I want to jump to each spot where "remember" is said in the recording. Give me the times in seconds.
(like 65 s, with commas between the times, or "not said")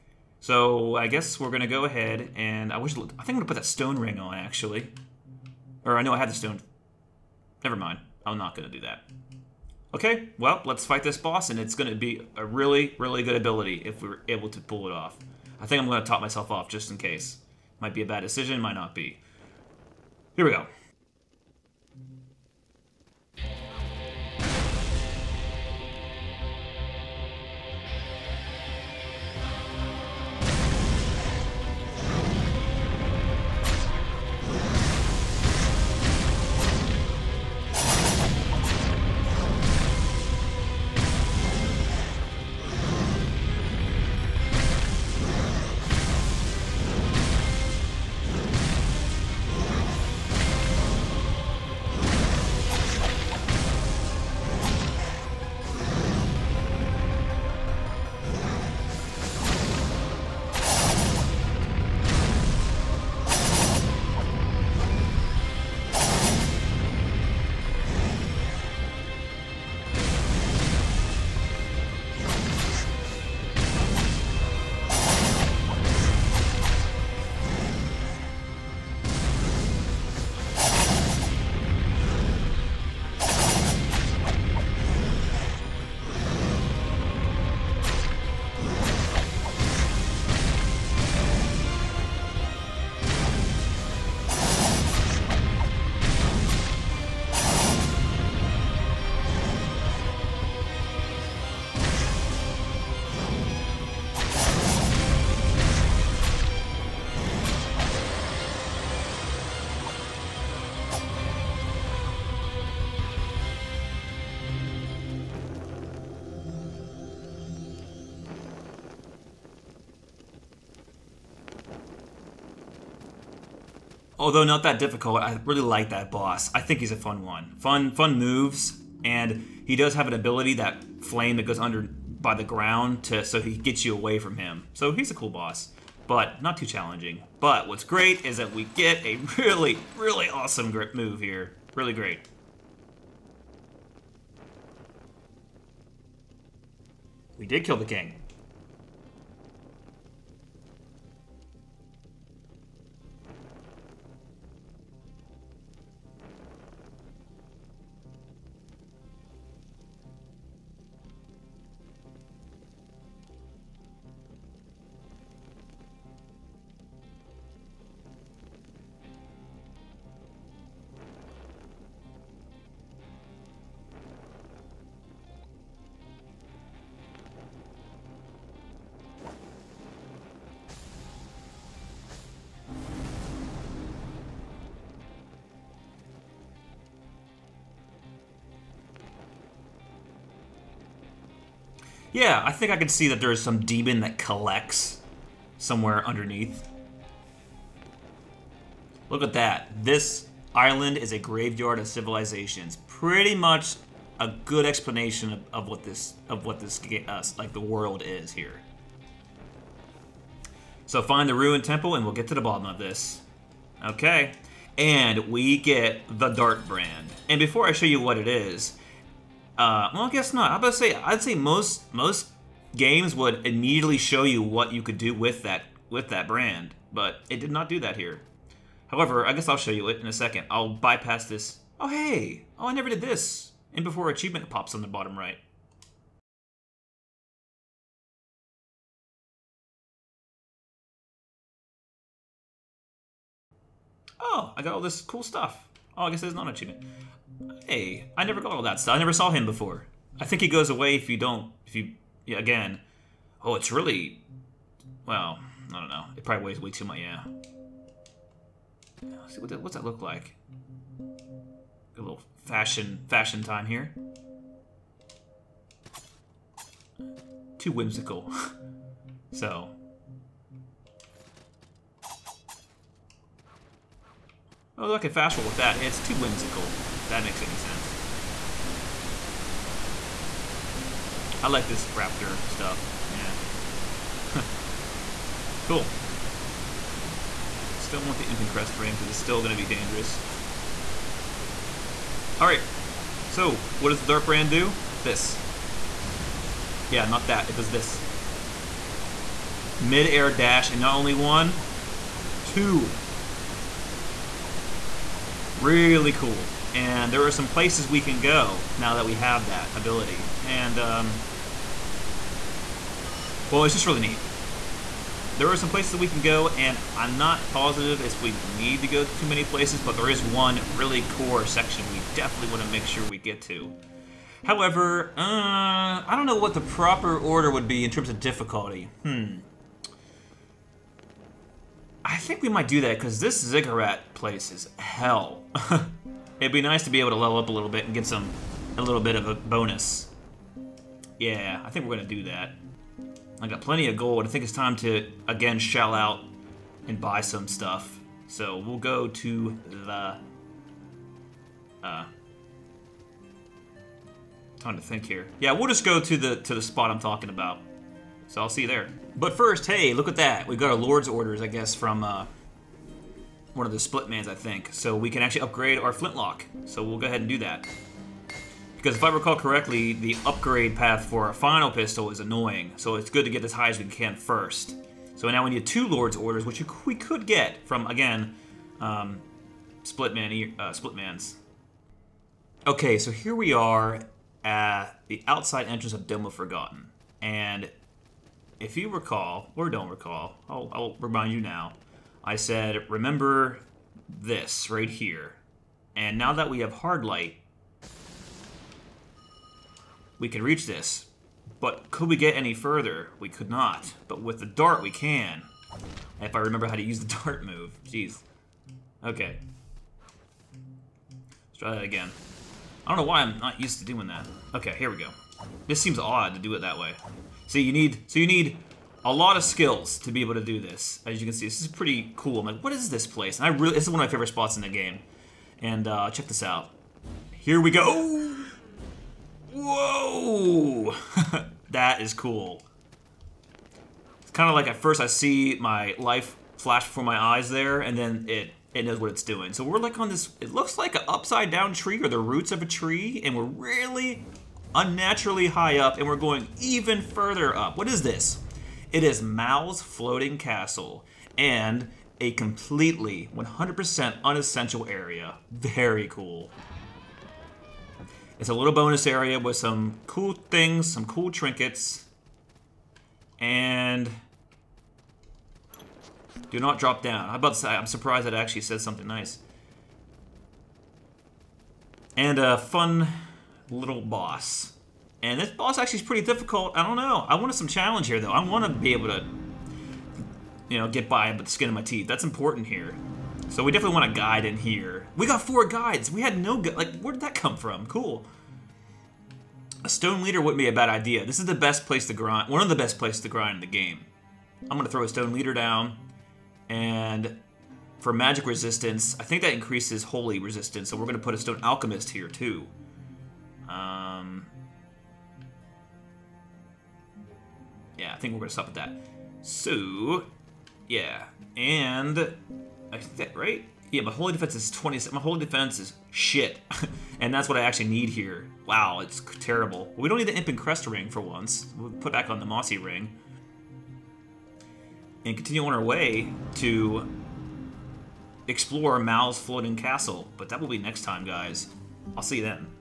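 392 s, 406 s.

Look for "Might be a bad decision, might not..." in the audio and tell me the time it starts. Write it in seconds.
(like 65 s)
17 s.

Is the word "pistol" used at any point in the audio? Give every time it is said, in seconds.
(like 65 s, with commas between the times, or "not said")
371 s.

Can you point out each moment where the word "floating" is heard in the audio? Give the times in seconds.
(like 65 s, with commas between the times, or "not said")
449 s, 529 s.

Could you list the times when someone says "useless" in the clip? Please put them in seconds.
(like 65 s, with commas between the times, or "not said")
not said.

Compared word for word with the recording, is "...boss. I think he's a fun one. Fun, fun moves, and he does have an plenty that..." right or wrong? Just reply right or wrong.
wrong.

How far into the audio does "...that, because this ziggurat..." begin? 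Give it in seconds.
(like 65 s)
332 s.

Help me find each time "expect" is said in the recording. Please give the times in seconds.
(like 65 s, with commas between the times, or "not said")
not said.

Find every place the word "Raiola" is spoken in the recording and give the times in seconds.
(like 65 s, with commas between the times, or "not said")
not said.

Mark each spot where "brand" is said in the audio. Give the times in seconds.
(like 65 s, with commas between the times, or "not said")
216 s, 226 s, 294 s.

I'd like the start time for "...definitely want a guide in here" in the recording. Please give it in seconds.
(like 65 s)
483 s.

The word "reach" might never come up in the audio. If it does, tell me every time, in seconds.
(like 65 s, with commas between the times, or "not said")
400 s.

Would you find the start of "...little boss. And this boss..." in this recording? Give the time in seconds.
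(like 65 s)
473 s.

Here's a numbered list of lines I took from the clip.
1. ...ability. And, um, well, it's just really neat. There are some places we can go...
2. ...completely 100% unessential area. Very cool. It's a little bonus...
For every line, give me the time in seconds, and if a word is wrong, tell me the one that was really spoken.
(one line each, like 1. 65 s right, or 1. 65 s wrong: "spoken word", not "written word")
1. 309 s right
2. 452 s right.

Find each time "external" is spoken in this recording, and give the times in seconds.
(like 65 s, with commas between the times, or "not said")
not said.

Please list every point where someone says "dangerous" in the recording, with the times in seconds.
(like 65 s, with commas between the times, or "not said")
289 s.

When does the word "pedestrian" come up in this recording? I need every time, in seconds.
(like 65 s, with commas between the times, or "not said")
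not said.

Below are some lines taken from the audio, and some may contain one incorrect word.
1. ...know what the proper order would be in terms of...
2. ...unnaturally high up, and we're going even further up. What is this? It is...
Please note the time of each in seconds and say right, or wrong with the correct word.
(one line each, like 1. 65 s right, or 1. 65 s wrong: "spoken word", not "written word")
1. 326 s right
2. 444 s right.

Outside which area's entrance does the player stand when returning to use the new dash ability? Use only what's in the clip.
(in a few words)
Dome of Forgotten.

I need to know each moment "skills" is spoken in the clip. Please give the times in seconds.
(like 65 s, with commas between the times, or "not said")
419 s.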